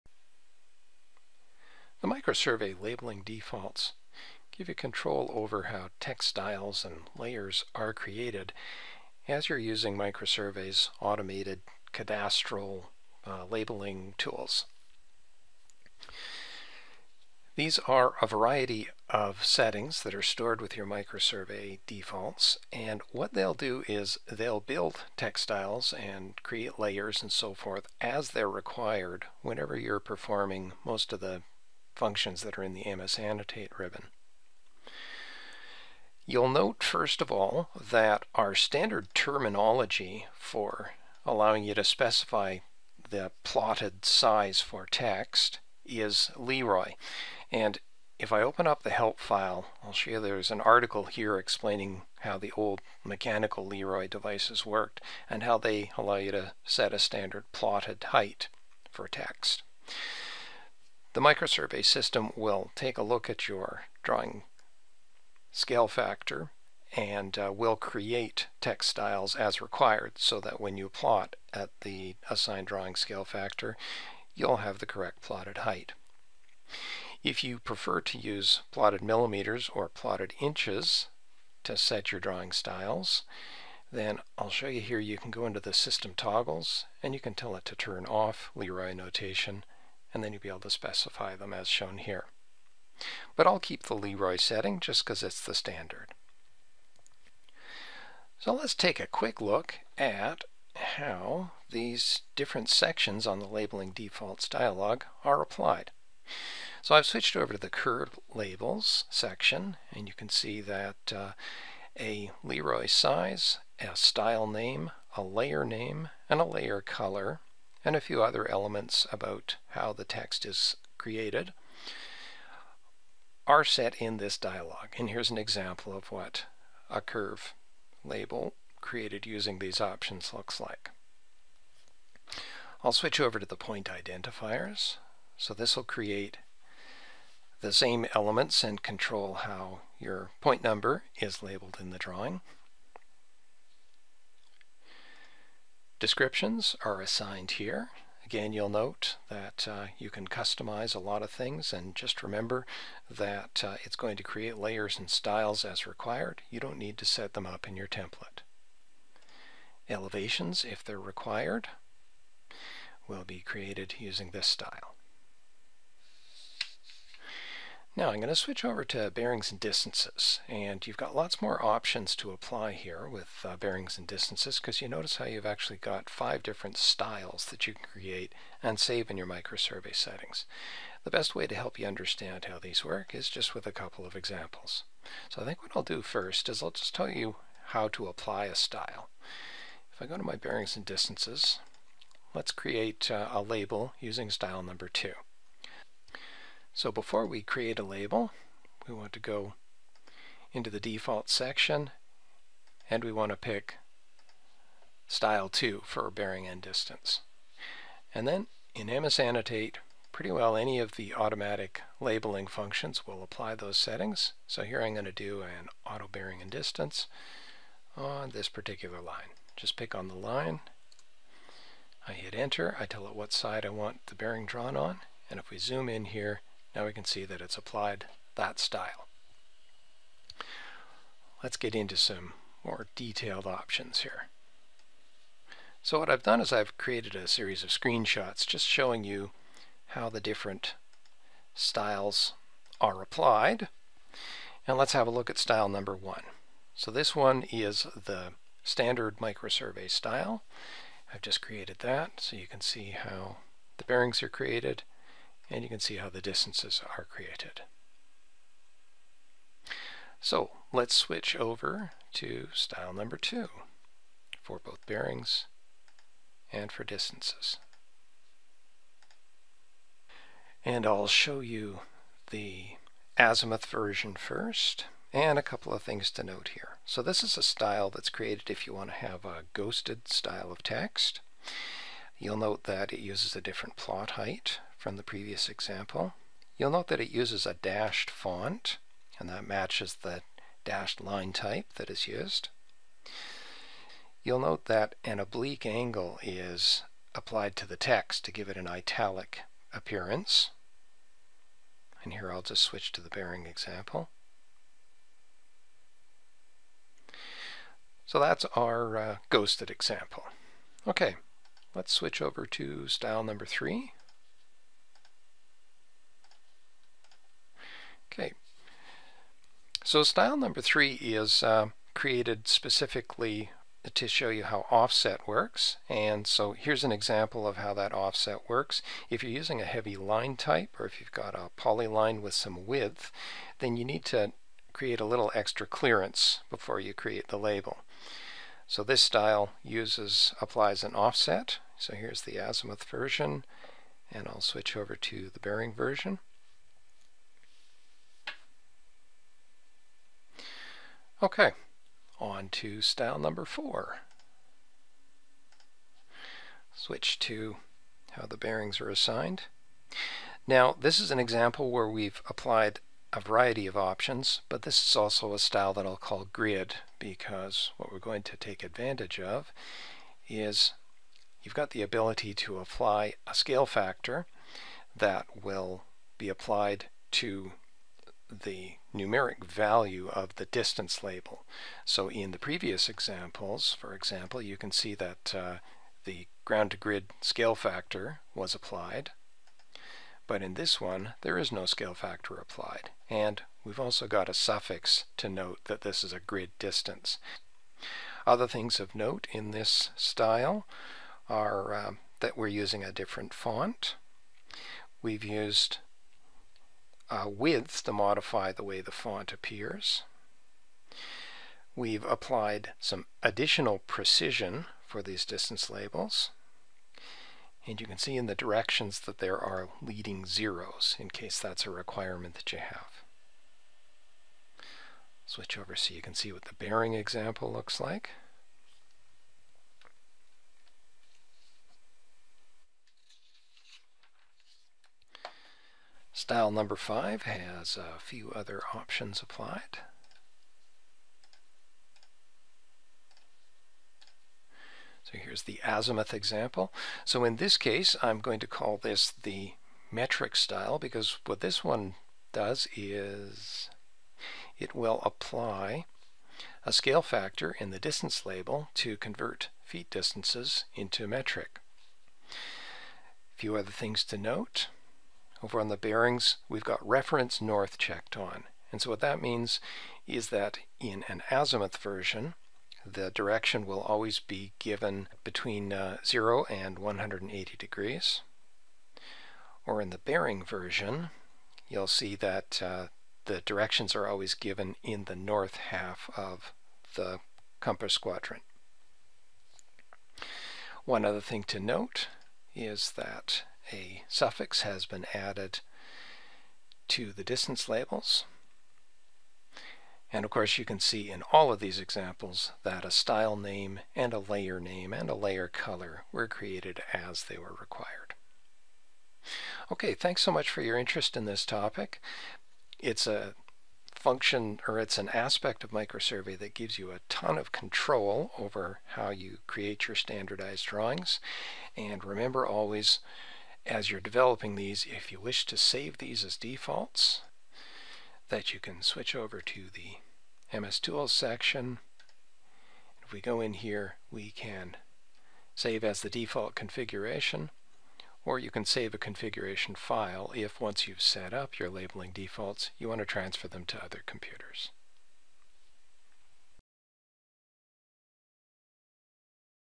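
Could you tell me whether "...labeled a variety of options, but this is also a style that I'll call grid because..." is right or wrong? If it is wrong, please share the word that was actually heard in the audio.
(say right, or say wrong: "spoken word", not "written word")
wrong: "applied", not "labeled".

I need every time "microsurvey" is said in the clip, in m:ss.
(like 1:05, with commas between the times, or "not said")
0:02, 0:09, 0:20, 1:01, 2:59, 4:09, 8:35.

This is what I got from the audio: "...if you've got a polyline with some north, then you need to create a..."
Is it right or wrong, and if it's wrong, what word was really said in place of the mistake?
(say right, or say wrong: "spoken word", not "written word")
wrong: "width", not "north".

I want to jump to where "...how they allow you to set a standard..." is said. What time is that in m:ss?
0:55.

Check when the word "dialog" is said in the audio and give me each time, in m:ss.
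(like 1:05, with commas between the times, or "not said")
1:44, 2:04.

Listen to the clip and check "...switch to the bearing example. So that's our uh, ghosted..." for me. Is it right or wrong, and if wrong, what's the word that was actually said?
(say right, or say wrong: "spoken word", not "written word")
right.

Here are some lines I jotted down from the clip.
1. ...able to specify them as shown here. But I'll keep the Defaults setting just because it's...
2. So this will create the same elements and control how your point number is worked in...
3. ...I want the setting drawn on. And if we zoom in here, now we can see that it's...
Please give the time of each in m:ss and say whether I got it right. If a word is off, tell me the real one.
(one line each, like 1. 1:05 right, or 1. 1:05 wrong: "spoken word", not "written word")
1. 1:30 wrong: "Leroy", not "Defaults"
2. 2:15 wrong: "labeled", not "worked"
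3. 3:43 wrong: "bearing", not "setting".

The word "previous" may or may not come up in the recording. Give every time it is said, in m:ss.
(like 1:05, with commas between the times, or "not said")
4:45, 6:22.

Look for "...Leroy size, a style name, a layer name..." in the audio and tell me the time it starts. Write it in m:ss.
1:52.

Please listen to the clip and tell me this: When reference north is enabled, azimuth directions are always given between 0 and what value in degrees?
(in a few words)
180.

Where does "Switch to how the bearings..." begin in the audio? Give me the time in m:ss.
5:56.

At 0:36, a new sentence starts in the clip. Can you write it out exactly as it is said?
You'll note, first of all, that our standard terminology for allowing you to specify the plotted size for text is Leroy.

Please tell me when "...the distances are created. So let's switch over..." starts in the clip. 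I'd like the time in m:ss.
4:16.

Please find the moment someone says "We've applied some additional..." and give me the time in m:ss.
6:51.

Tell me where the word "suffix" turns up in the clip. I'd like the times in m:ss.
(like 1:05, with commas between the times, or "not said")
6:34, 8:14.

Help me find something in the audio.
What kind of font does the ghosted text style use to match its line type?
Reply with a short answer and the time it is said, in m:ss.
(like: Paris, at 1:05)
dashed font, at 4:47.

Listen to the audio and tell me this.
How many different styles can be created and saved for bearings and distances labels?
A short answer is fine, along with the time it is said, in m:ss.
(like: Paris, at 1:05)
5, at 2:56.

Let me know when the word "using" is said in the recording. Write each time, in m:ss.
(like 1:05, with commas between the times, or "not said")
0:09, 2:09, 2:43, 3:13, 5:29, 6:42.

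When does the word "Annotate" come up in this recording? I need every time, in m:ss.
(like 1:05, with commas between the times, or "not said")
0:33, 3:29.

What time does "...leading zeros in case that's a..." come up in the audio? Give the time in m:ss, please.
6:59.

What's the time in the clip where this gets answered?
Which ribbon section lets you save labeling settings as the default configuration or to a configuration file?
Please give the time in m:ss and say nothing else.
8:50.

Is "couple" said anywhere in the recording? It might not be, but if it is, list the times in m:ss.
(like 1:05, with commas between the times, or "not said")
3:03, 4:35.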